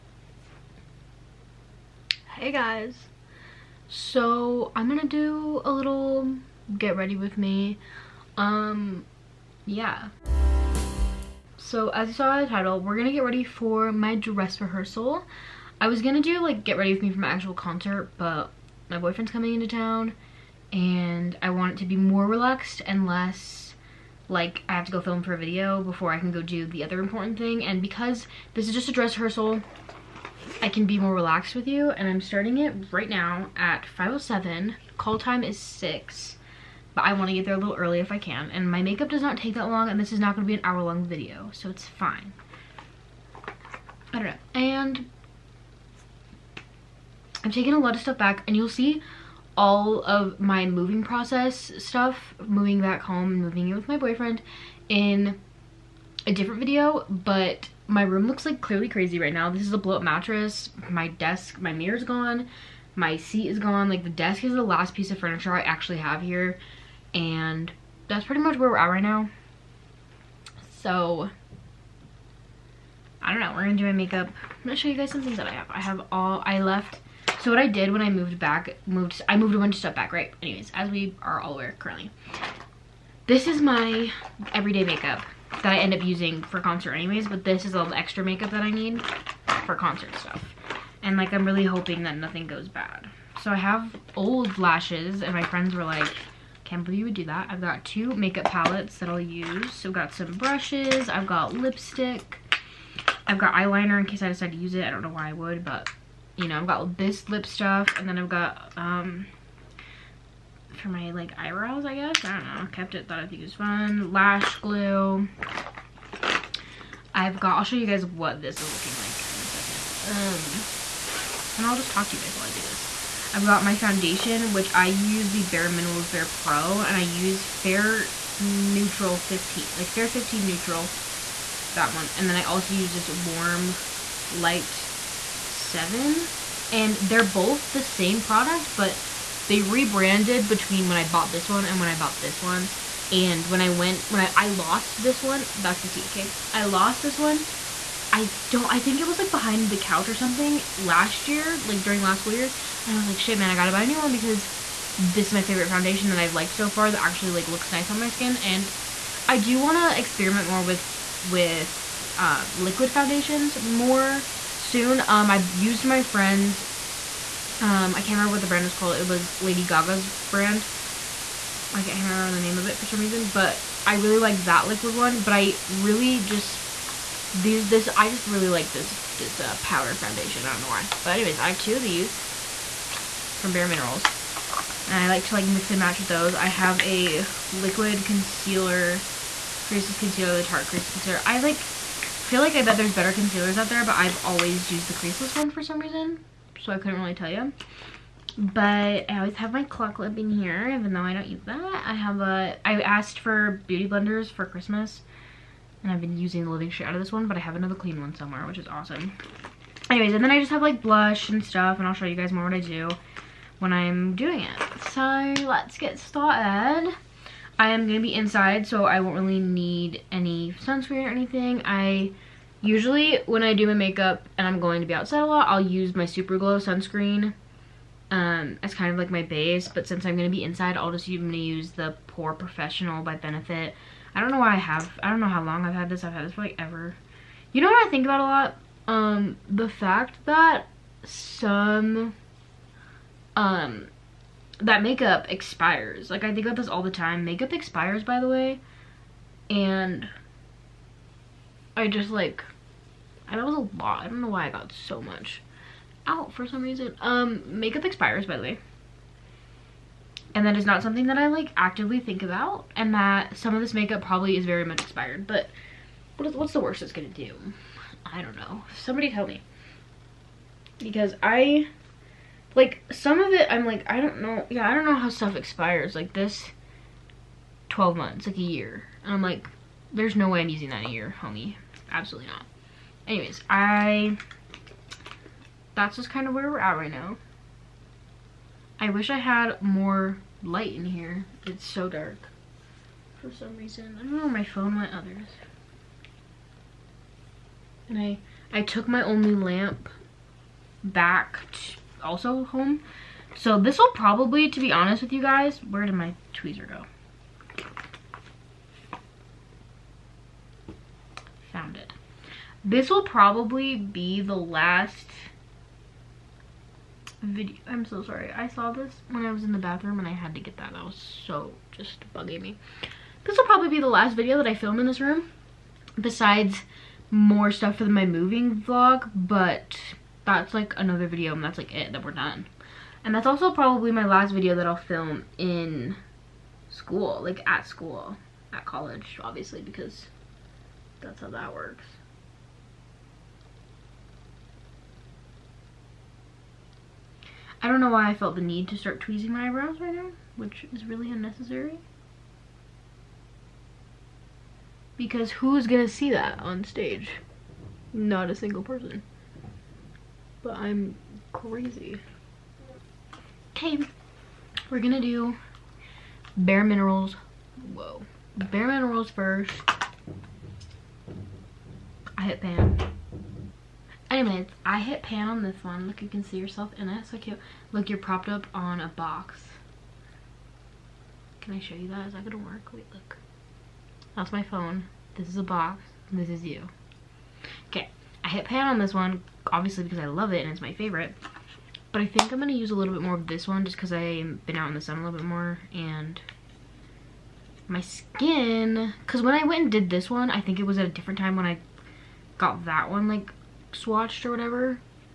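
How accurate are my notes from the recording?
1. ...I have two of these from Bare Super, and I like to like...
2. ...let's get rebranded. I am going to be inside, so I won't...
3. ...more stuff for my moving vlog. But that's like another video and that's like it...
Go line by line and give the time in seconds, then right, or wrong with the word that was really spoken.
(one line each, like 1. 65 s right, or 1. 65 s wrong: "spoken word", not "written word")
1. 181 s wrong: "Minerals", not "Super"
2. 215 s wrong: "started", not "rebranded"
3. 327 s right.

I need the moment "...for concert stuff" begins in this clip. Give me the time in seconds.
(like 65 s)
89 s.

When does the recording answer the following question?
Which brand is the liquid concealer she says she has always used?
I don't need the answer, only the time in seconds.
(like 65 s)
190 s.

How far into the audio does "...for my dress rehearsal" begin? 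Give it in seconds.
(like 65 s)
13 s.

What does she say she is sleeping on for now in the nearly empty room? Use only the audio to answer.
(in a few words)
Blow up mattress.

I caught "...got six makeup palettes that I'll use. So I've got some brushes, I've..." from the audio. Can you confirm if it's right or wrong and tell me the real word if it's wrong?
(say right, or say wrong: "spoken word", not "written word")
wrong: "two", not "six".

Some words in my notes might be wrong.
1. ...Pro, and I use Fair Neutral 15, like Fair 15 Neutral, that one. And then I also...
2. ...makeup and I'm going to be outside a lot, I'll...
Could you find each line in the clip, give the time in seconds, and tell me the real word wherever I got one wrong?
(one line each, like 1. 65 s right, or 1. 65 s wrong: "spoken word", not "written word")
1. 126 s right
2. 223 s right.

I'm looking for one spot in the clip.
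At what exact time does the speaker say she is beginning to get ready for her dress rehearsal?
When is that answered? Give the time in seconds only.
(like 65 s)
33 s.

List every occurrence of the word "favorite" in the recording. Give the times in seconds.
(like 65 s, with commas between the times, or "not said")
155 s, 390 s.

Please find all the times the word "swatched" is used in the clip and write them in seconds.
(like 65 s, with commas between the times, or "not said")
403 s.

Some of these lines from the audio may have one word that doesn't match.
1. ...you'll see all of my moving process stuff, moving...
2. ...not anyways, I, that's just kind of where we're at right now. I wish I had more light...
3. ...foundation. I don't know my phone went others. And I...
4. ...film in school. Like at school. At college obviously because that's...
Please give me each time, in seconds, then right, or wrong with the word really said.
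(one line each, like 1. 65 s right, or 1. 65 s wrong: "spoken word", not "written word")
1. 48 s right
2. 282 s right
3. 293 s wrong: "reason", not "foundation"
4. 334 s right.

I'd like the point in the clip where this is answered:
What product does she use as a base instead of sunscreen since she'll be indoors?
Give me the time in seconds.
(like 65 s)
232 s.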